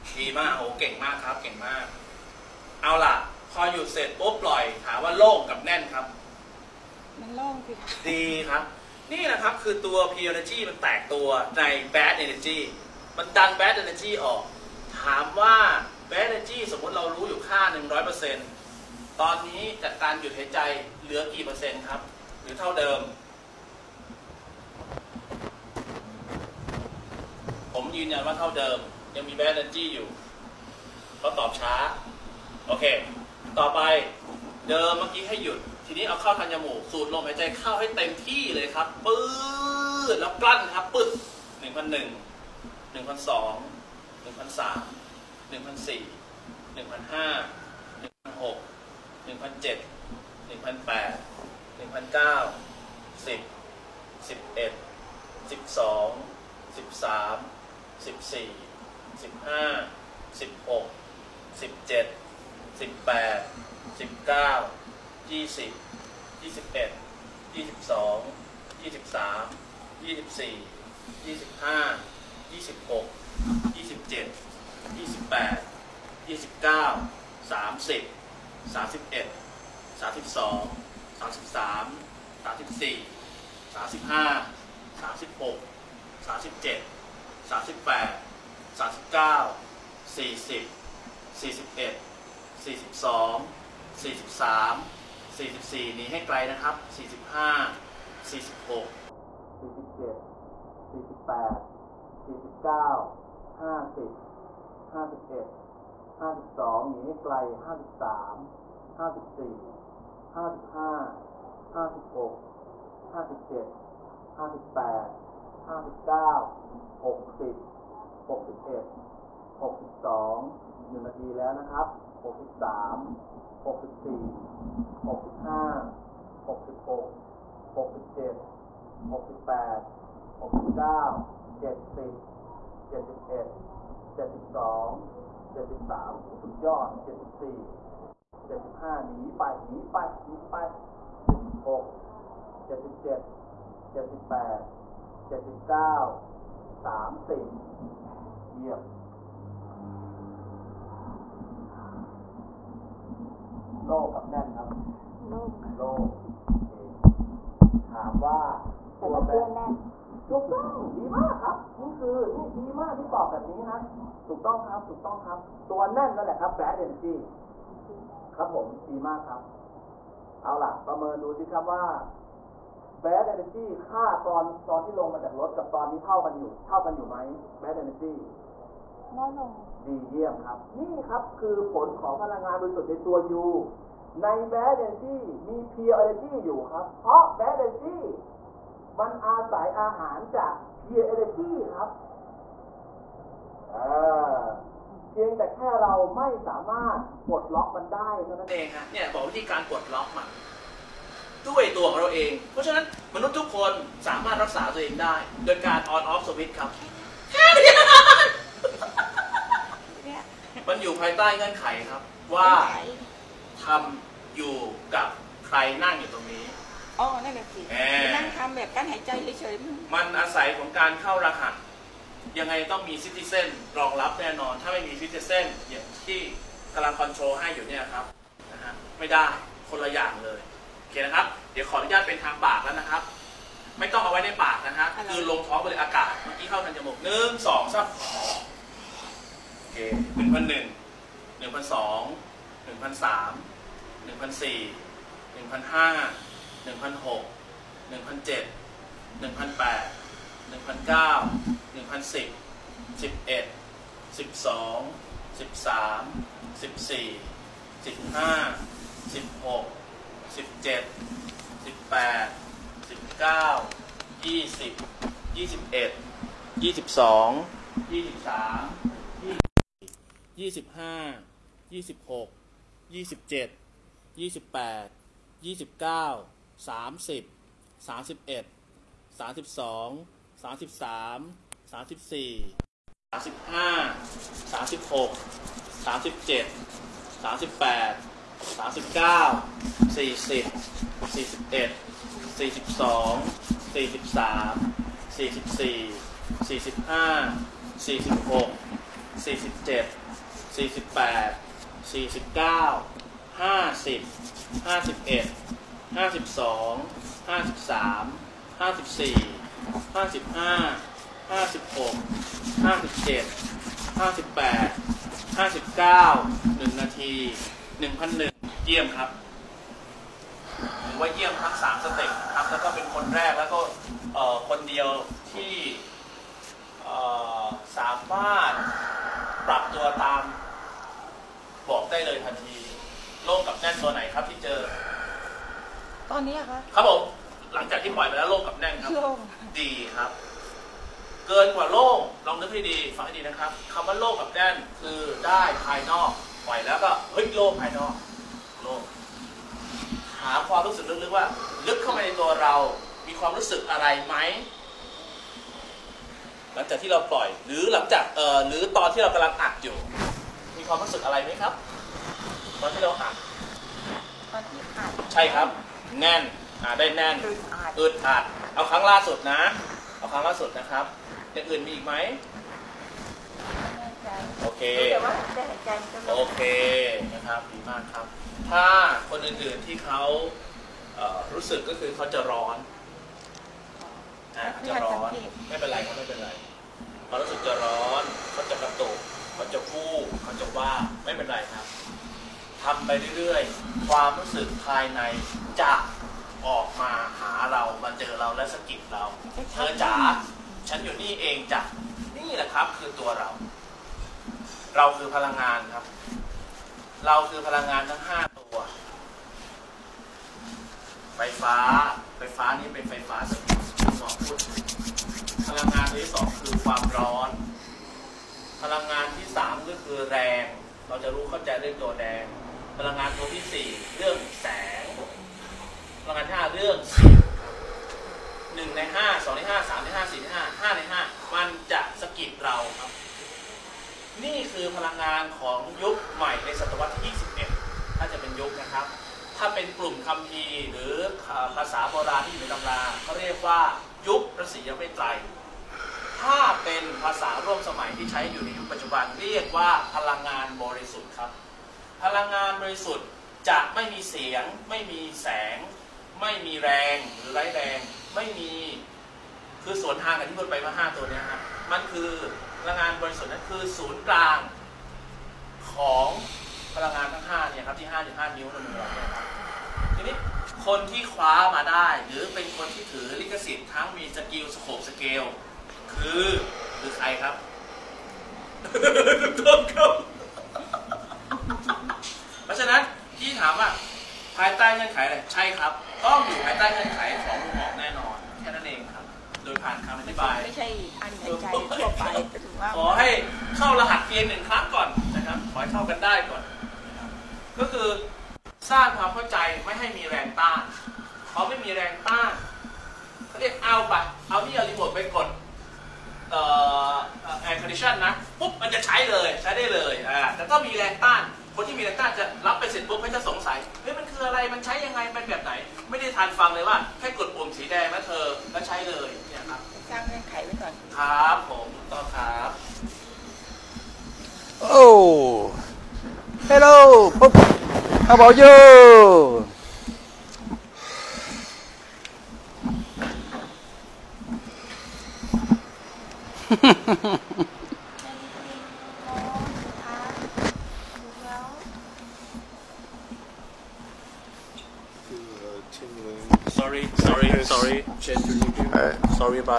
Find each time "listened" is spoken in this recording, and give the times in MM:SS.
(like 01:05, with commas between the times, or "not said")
not said.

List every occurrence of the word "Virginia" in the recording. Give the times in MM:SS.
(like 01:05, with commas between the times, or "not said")
not said.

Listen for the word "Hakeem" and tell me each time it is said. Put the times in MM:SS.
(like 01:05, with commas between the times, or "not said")
not said.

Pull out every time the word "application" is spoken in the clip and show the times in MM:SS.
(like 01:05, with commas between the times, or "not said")
not said.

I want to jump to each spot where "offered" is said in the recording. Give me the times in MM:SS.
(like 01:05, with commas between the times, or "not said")
not said.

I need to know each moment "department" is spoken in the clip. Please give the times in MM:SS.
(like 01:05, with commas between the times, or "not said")
not said.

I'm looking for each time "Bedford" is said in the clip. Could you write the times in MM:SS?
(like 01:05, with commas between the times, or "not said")
not said.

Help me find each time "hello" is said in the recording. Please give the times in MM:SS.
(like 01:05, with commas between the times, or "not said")
08:57.